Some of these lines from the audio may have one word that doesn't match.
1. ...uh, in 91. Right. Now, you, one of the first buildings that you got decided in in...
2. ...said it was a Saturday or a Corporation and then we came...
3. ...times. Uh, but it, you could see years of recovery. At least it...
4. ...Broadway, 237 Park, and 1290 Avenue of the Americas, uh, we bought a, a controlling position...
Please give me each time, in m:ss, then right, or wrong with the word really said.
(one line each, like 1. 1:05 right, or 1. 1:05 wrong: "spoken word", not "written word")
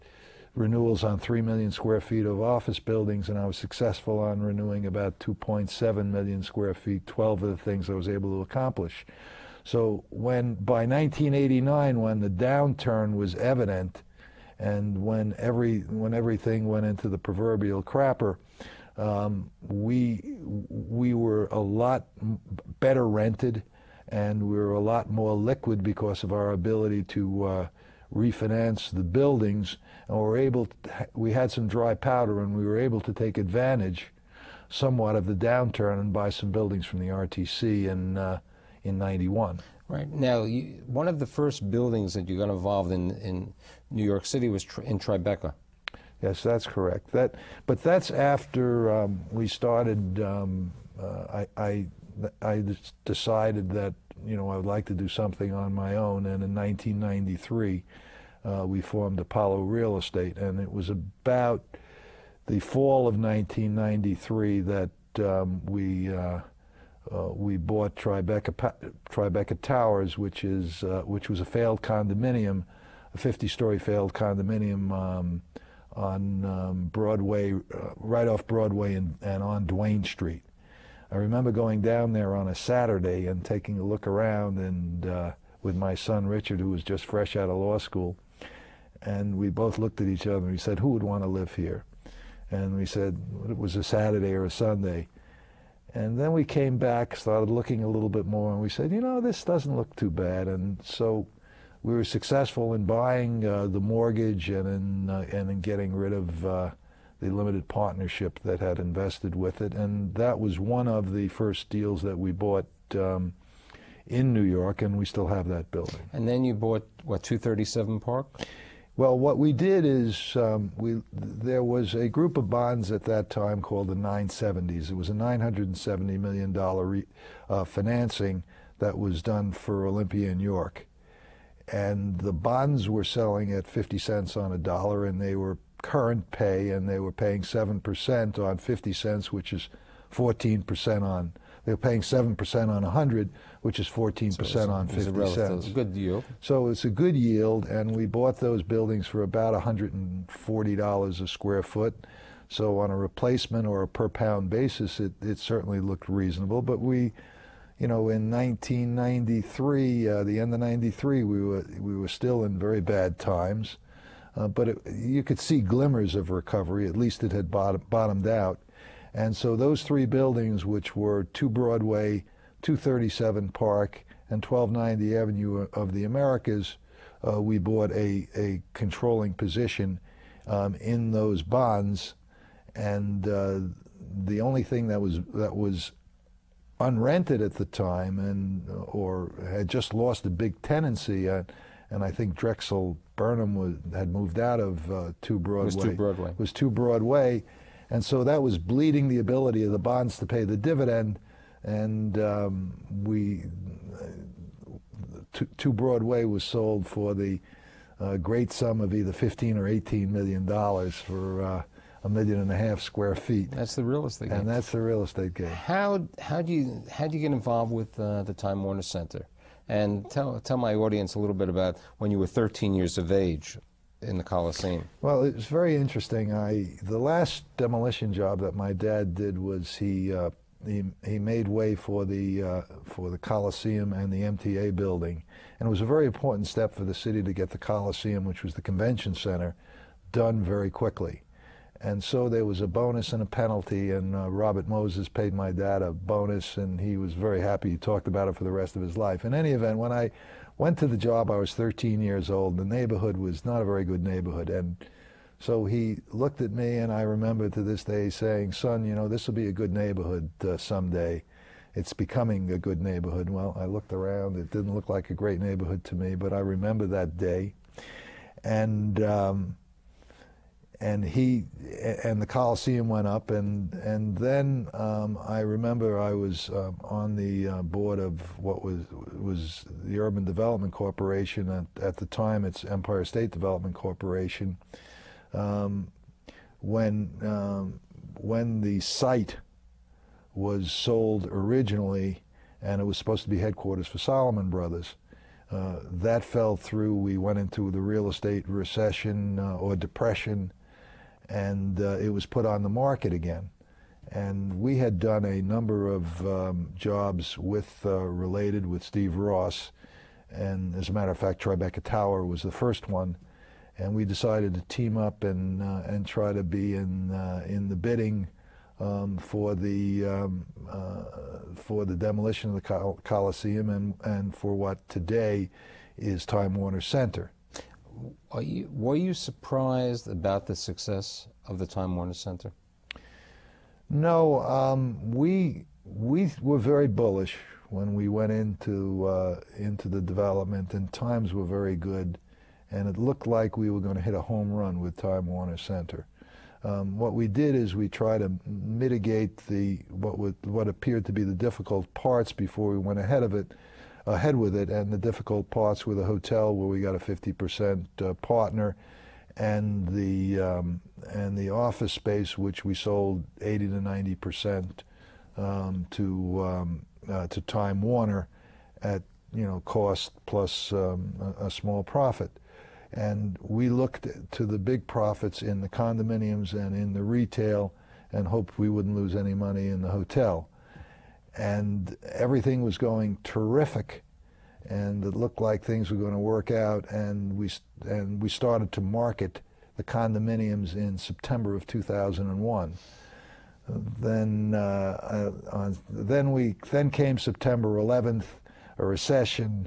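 1. 0:38 wrong: "involved", not "decided"
2. 1:32 wrong: "Sunday", not "Corporation"
3. 2:43 wrong: "glimmers", not "years"
4. 2:51 right.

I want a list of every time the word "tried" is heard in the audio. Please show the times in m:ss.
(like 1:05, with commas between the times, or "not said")
5:47.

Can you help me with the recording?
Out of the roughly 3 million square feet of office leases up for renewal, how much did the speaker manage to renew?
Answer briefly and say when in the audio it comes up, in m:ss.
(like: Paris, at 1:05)
2.7 million square feet, at 0:05.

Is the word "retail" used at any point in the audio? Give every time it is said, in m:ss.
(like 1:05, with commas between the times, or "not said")
6:17.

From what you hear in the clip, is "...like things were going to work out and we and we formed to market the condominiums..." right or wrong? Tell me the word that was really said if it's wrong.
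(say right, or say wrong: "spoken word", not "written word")
wrong: "started", not "formed".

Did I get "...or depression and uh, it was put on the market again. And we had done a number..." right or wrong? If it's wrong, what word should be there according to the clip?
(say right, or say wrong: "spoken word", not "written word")
right.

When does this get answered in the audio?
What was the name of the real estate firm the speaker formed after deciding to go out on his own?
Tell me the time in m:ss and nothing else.
0:59.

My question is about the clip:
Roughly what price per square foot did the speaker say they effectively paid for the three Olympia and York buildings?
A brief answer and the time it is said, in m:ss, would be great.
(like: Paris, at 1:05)
$140, at 2:29.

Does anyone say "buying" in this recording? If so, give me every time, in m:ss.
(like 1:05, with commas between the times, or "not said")
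1:42.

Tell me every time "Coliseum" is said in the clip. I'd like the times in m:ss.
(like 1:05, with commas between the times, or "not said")
3:44, 3:53, 3:57, 4:32, 5:23.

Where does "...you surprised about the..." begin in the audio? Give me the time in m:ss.
5:28.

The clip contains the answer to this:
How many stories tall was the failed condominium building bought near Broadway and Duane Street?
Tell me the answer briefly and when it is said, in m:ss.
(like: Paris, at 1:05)
50, at 1:13.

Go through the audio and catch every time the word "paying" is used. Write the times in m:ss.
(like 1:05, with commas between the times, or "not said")
2:17, 2:21.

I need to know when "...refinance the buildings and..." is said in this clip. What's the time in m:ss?
0:28.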